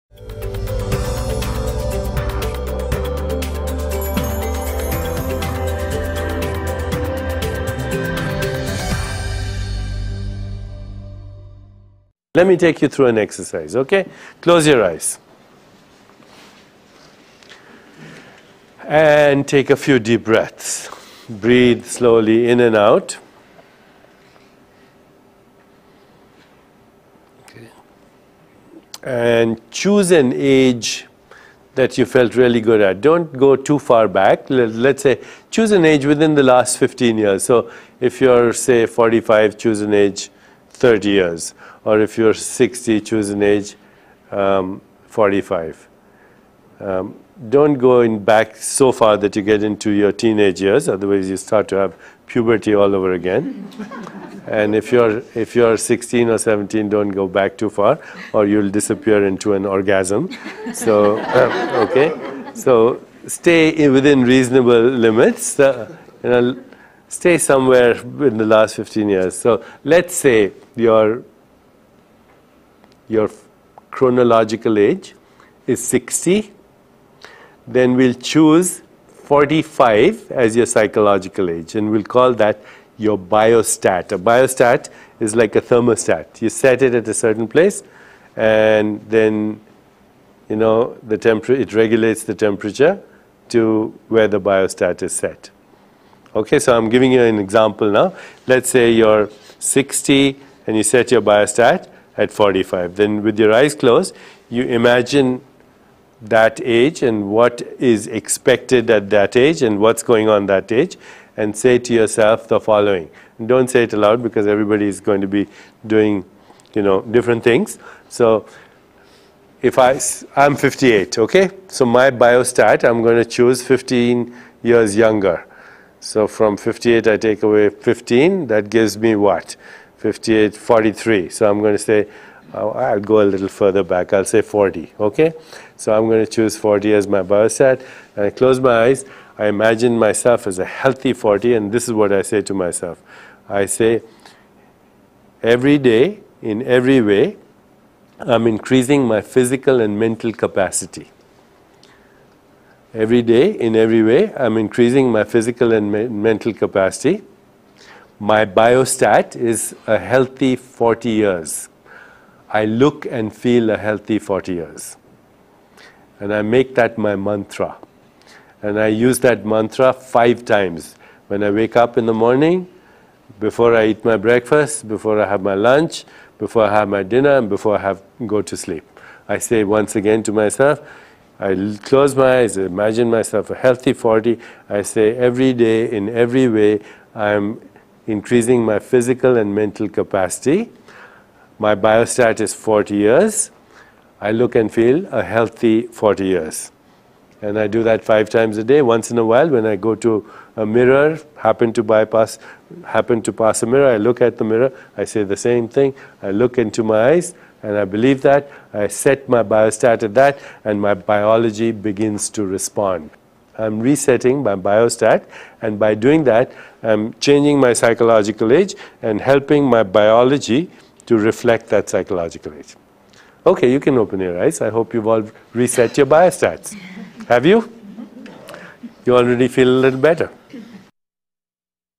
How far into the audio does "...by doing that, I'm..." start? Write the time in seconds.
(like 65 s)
215 s.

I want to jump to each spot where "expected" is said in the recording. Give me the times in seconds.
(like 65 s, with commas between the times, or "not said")
108 s.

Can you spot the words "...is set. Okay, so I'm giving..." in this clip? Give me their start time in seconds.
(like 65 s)
95 s.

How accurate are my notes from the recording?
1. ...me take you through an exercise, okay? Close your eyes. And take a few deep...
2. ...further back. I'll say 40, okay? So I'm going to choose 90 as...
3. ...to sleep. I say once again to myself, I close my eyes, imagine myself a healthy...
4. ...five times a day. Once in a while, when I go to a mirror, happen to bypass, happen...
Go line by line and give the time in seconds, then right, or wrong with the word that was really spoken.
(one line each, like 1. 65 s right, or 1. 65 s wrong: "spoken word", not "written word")
1. 12 s right
2. 133 s wrong: "40", not "90"
3. 178 s right
4. 198 s right.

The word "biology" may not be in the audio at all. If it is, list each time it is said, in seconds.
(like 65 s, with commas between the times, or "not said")
210 s, 219 s.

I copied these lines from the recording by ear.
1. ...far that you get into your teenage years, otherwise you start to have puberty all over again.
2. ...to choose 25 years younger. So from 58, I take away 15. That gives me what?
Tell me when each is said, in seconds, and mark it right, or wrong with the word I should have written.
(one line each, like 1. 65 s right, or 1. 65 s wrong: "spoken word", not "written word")
1. 48 s right
2. 123 s wrong: "15", not "25".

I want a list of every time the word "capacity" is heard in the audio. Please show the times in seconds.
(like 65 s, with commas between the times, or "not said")
150 s, 156 s, 189 s.